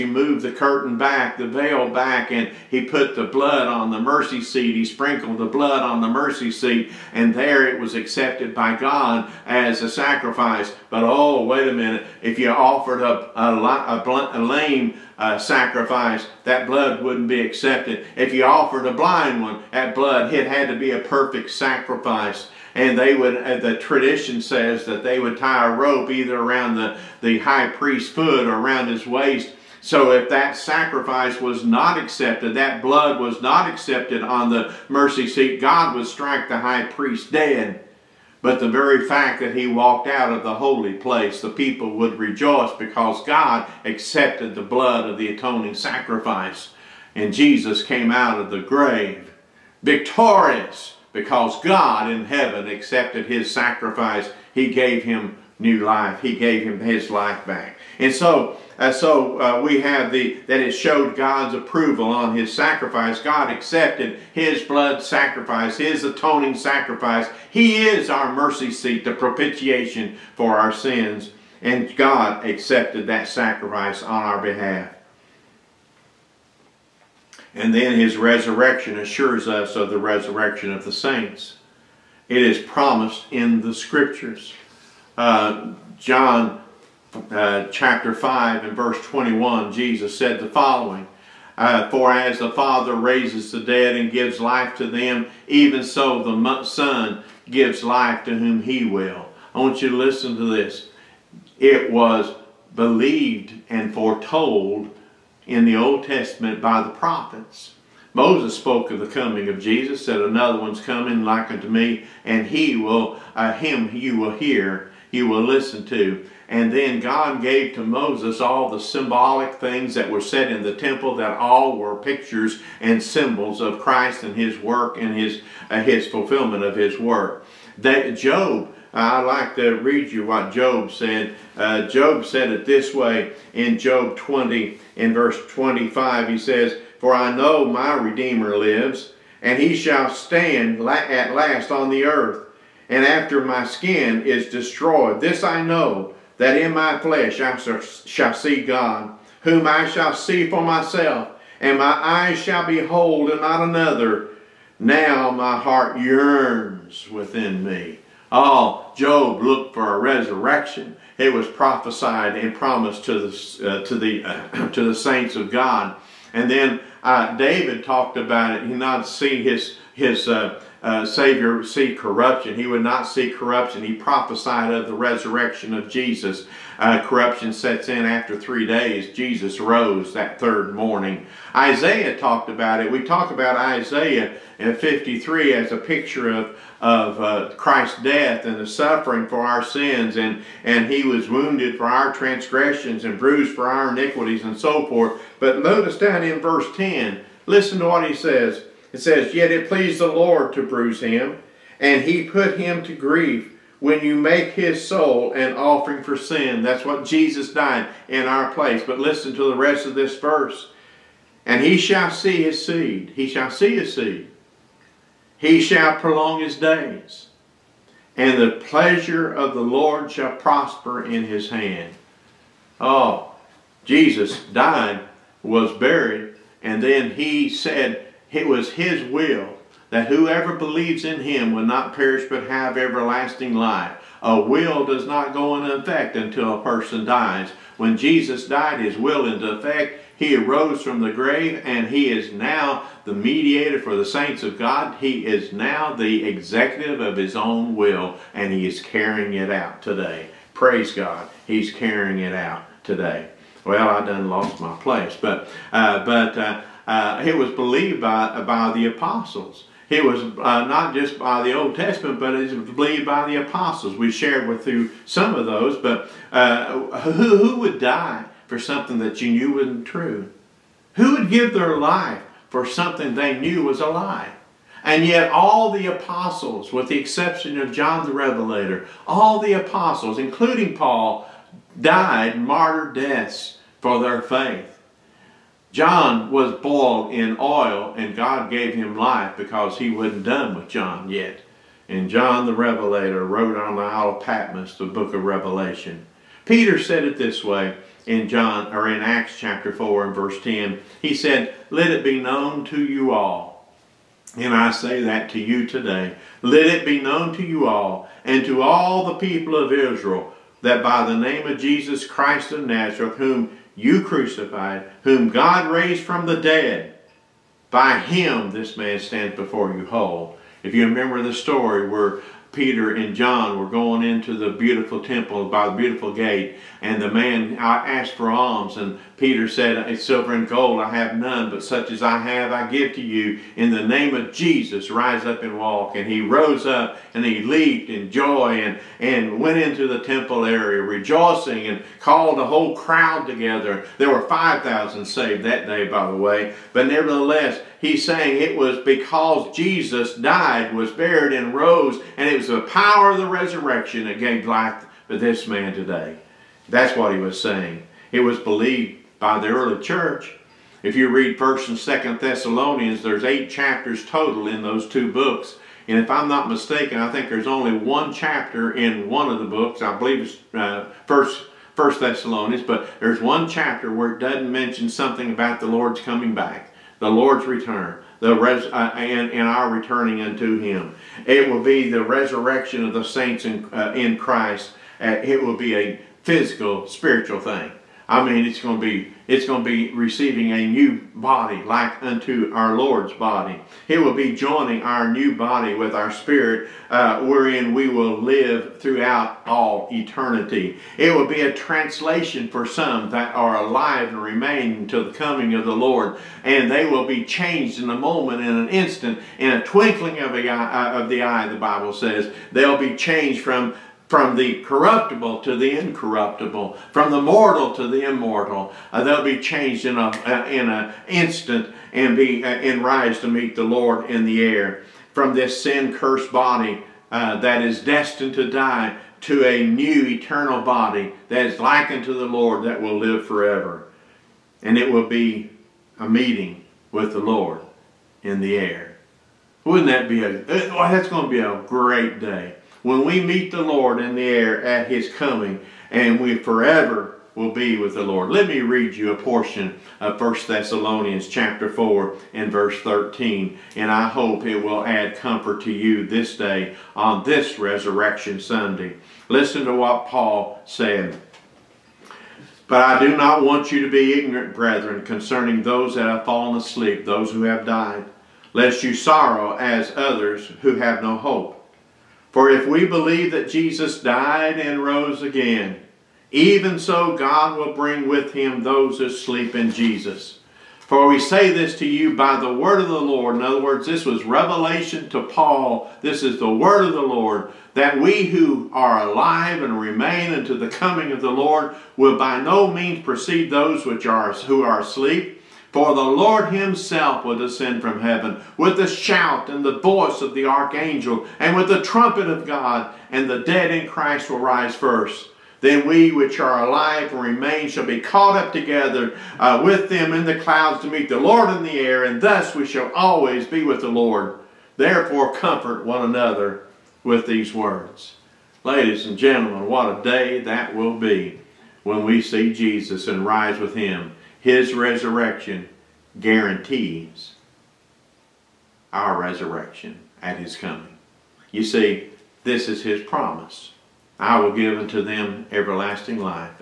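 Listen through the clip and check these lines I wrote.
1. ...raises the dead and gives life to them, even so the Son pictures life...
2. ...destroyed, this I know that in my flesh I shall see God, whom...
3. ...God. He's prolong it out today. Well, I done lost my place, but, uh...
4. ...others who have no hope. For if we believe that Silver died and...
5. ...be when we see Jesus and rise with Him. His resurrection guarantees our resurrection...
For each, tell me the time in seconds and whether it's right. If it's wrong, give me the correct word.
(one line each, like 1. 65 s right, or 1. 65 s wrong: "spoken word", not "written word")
1. 92 s wrong: "gives", not "pictures"
2. 144 s right
3. 250 s wrong: "carrying", not "prolong"
4. 469 s wrong: "Jesus", not "Silver"
5. 520 s right.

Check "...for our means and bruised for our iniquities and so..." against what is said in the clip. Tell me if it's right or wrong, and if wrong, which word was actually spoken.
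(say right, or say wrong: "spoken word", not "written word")
wrong: "transgressions", not "means".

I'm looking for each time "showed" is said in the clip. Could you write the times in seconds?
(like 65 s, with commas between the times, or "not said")
60 s.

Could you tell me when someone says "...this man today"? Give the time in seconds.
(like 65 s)
355 s.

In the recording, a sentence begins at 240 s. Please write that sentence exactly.
He arose from the grave and he is now the mediator for the saints of God.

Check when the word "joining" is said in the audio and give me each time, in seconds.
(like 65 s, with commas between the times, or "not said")
394 s.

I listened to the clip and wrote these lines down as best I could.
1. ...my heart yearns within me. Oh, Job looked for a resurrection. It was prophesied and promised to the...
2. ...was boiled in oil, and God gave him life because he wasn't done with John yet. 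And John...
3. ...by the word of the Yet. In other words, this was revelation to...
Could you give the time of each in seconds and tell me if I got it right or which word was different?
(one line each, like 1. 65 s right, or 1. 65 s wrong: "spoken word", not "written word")
1. 155 s right
2. 286 s right
3. 482 s wrong: "Lord", not "Yet".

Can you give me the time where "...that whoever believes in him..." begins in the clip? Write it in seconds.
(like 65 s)
229 s.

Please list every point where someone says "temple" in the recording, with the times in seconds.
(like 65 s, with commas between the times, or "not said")
120 s, 325 s, 340 s.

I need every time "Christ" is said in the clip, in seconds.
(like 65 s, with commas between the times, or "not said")
123 s, 187 s, 312 s, 384 s, 503 s.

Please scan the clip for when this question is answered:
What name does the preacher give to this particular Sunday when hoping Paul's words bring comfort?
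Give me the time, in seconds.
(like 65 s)
457 s.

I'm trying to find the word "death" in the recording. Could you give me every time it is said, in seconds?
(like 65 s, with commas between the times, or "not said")
188 s, 282 s.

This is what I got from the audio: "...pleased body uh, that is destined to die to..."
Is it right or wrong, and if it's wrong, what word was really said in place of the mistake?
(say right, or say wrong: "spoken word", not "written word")
wrong: "cursed", not "pleased".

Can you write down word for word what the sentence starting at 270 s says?
Who would give their life for something they knew was a lie?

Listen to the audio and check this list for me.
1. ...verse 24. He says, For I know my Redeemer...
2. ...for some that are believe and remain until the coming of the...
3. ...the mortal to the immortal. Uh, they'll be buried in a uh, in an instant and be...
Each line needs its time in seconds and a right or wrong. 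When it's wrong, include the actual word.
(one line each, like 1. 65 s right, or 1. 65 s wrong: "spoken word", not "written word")
1. 135 s wrong: "25", not "24"
2. 402 s wrong: "alive", not "believe"
3. 417 s wrong: "changed", not "buried".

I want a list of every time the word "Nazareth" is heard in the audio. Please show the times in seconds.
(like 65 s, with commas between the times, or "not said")
312 s.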